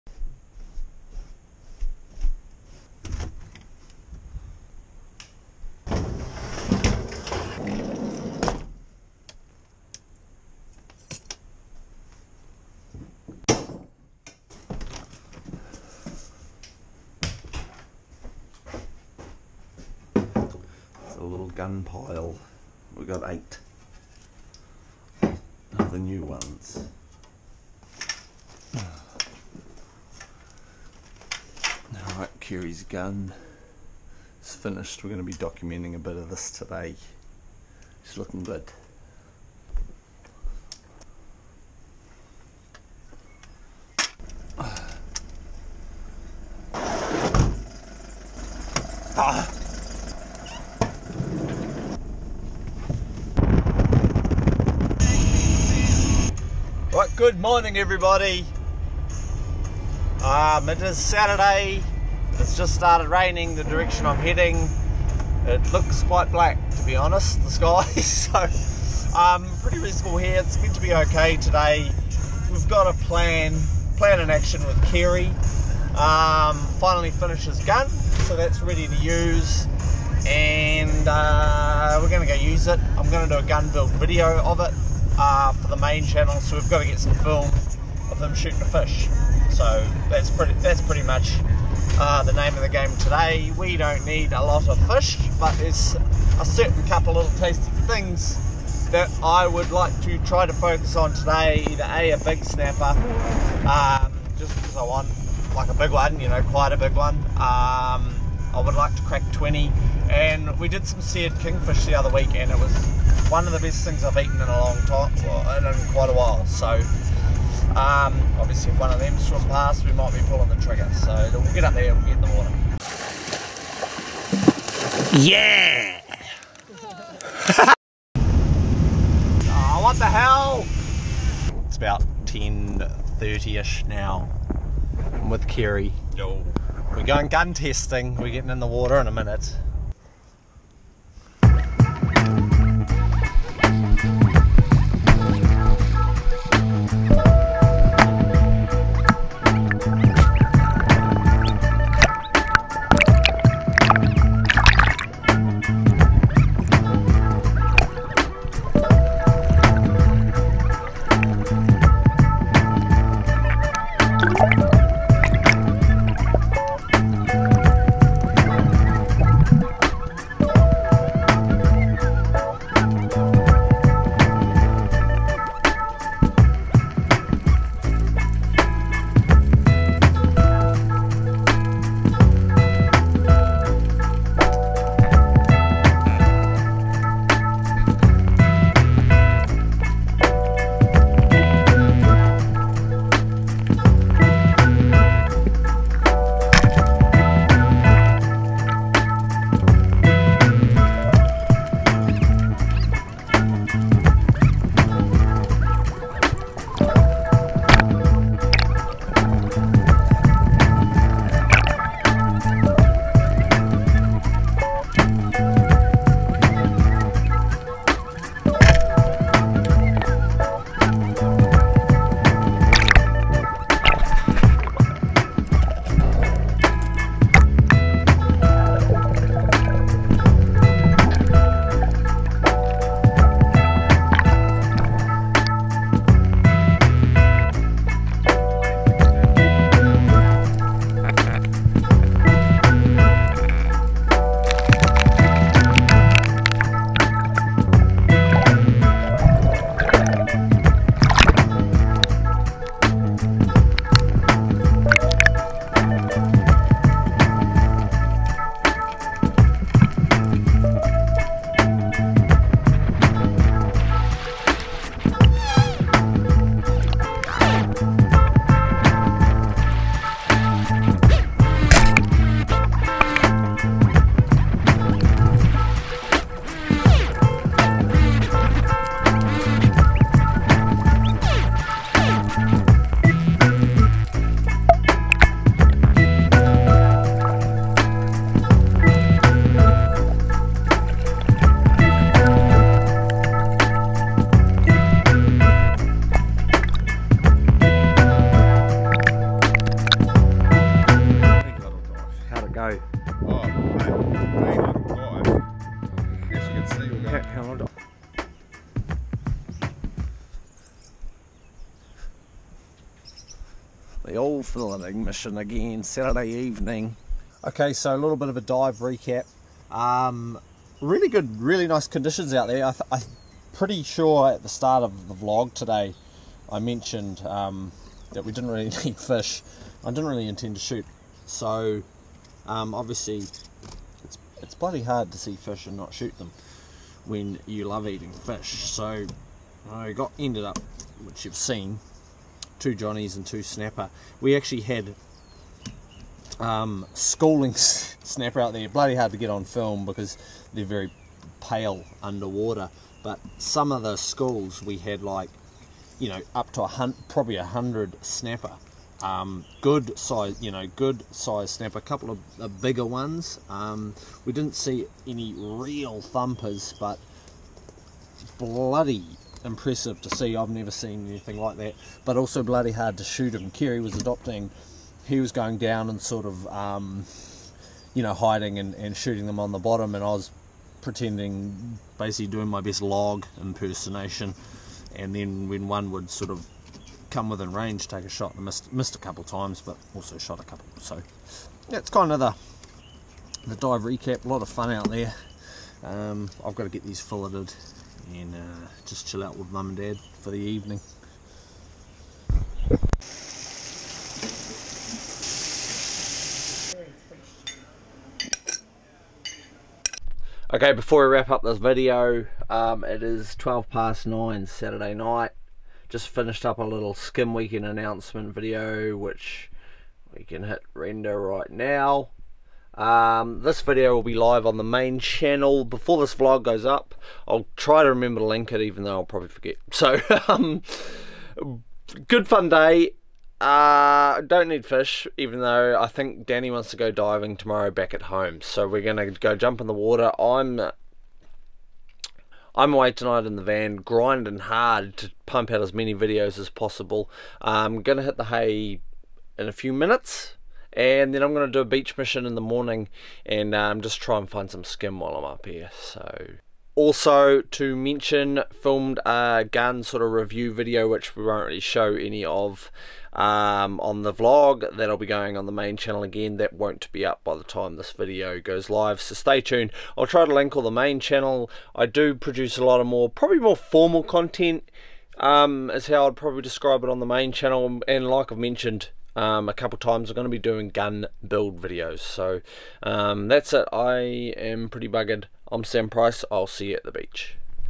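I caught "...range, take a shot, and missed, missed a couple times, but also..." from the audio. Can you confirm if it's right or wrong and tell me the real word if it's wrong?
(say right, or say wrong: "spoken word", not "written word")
right.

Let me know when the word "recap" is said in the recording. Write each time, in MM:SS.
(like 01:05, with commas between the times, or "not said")
05:18, 06:33.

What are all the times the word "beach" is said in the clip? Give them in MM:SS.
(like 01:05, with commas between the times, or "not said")
07:31, 08:06.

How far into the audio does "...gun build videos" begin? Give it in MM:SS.
08:00.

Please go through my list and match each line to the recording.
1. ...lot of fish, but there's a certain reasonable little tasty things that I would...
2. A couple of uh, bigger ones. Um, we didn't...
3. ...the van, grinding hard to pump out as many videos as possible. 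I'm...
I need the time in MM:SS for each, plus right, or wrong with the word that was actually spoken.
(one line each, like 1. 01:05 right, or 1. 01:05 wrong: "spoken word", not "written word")
1. 01:34 wrong: "couple", not "reasonable"
2. 06:01 right
3. 07:23 right.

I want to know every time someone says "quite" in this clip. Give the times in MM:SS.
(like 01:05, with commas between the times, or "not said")
01:06, 01:46, 01:55.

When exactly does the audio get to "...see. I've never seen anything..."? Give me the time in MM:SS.
06:10.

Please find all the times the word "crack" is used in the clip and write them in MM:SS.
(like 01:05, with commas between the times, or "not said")
01:49.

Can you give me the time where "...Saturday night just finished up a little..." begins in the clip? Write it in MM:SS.
06:54.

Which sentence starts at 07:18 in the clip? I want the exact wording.
So we're going to go jump in the water.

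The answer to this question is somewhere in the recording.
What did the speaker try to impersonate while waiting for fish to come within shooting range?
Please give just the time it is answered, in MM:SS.
06:22.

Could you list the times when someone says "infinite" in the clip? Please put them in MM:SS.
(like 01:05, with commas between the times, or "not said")
not said.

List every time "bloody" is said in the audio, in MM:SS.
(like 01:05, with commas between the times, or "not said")
05:34, 05:48, 06:08, 06:12.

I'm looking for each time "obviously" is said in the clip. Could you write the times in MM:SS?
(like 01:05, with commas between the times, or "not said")
01:58, 05:32.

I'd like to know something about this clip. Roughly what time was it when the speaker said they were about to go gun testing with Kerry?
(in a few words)
10:30.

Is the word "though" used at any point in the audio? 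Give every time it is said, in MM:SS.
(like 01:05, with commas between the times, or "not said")
07:08, 07:15.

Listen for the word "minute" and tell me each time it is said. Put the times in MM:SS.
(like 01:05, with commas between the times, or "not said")
02:19, 07:29.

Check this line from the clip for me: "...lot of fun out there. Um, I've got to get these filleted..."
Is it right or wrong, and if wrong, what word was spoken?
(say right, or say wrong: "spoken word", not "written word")
right.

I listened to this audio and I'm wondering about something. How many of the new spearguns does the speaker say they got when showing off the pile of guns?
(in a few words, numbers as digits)
8.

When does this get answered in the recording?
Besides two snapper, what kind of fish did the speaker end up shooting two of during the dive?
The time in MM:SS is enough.
05:42.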